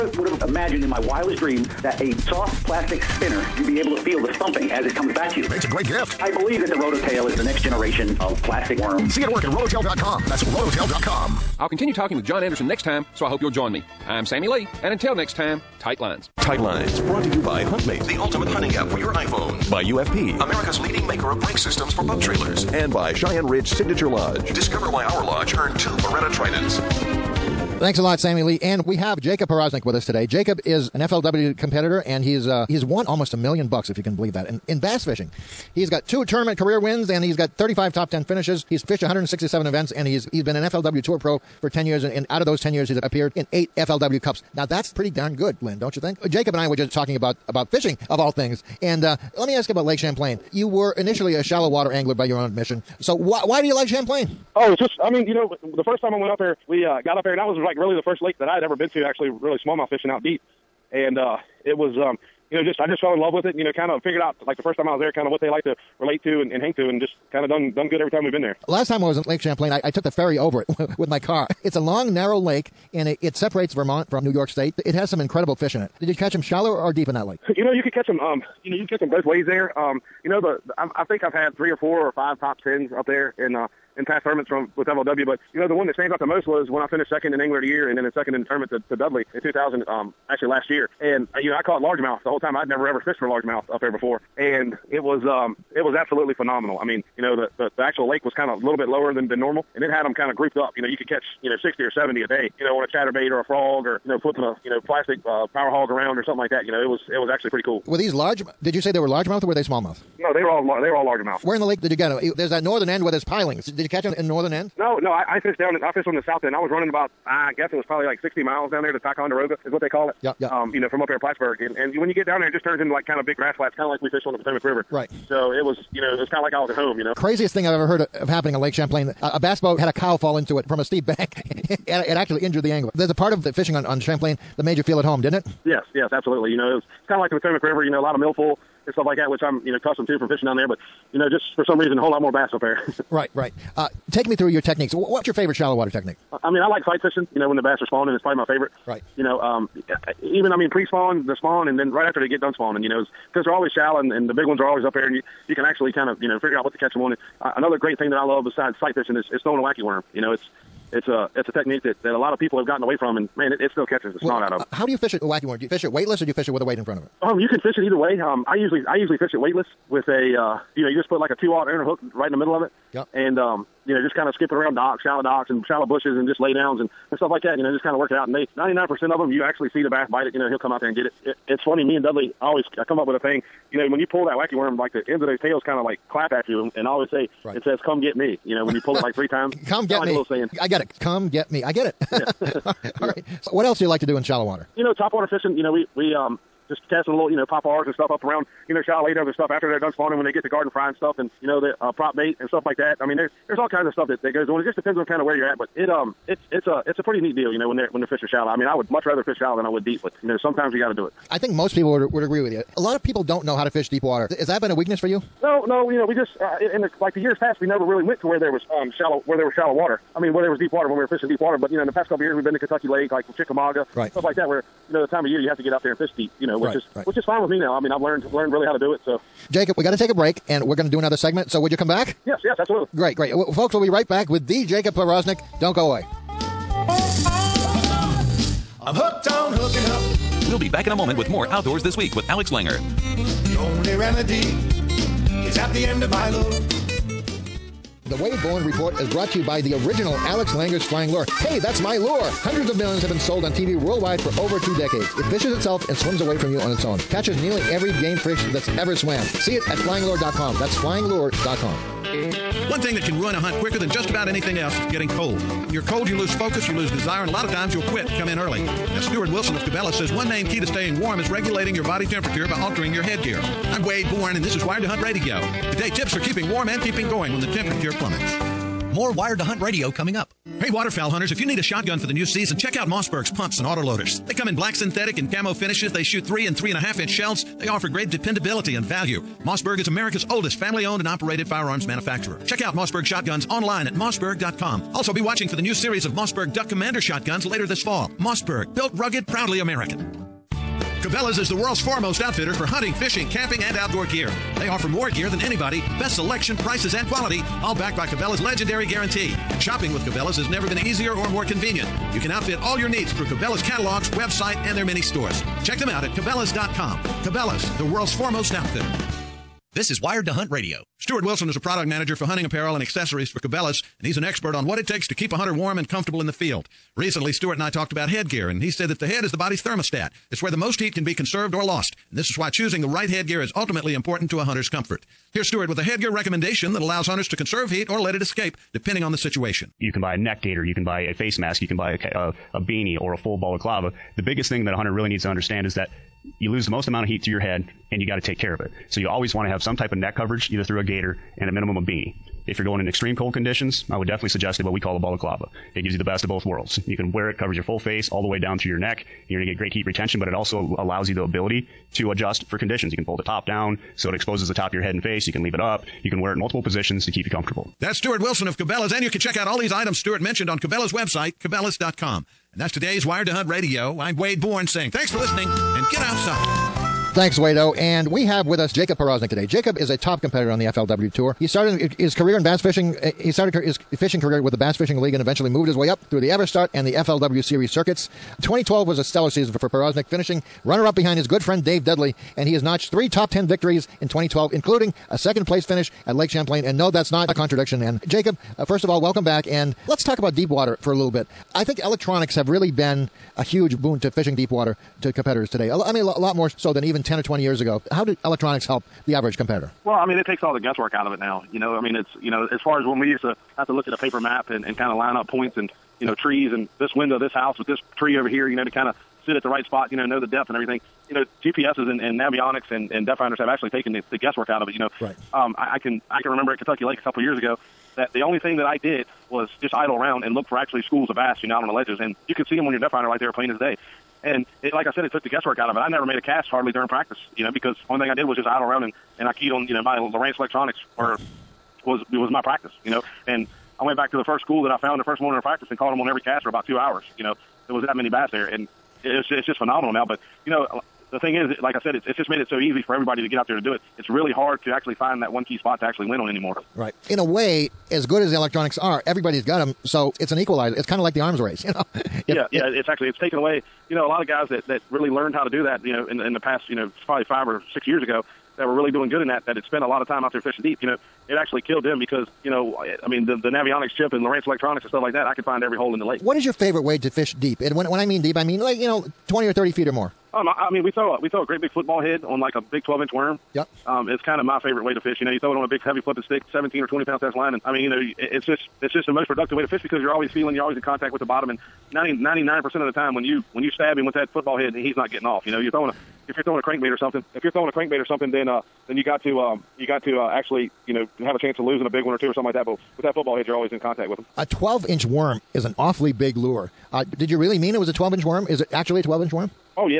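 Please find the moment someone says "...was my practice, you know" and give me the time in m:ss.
7:22.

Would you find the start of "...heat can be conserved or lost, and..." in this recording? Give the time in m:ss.
5:30.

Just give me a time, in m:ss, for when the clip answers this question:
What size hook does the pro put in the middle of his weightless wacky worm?
2:51.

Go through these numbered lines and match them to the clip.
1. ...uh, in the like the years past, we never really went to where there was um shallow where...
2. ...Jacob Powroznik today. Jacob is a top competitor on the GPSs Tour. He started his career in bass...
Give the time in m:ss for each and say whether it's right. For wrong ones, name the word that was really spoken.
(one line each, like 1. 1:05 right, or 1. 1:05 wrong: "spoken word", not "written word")
1. 3:36 right
2. 6:18 wrong: "FLW", not "GPSs".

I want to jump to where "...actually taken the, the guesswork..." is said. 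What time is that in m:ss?
7:03.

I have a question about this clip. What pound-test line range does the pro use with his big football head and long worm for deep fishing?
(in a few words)
17 or 20 pound.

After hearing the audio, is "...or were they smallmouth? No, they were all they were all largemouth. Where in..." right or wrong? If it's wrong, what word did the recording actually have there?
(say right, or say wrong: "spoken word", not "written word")
right.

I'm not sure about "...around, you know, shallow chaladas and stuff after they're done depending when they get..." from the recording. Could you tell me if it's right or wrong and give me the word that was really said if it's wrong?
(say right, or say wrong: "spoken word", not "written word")
wrong: "spawning", not "depending".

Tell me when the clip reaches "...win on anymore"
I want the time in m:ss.
7:36.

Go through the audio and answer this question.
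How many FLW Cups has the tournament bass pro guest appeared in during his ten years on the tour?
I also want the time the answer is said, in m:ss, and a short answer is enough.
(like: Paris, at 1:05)
8, at 0:43.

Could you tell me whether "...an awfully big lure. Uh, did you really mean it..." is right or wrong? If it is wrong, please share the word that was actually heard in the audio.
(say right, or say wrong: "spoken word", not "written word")
right.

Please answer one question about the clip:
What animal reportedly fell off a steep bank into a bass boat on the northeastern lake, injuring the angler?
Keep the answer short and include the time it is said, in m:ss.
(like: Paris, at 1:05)
A cow, at 2:09.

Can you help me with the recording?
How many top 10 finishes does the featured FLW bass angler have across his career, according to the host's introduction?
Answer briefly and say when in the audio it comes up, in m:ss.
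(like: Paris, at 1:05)
35, at 0:37.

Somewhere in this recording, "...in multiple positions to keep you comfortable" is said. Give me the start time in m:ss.
6:06.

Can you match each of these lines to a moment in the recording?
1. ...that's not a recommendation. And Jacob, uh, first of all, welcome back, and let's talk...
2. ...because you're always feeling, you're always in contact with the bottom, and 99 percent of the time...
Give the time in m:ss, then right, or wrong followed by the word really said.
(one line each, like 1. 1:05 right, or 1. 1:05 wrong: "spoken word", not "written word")
1. 6:36 wrong: "contradiction", not "recommendation"
2. 8:09 right.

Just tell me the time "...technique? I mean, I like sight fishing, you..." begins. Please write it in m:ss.
2:25.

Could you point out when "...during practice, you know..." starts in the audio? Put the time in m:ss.
7:16.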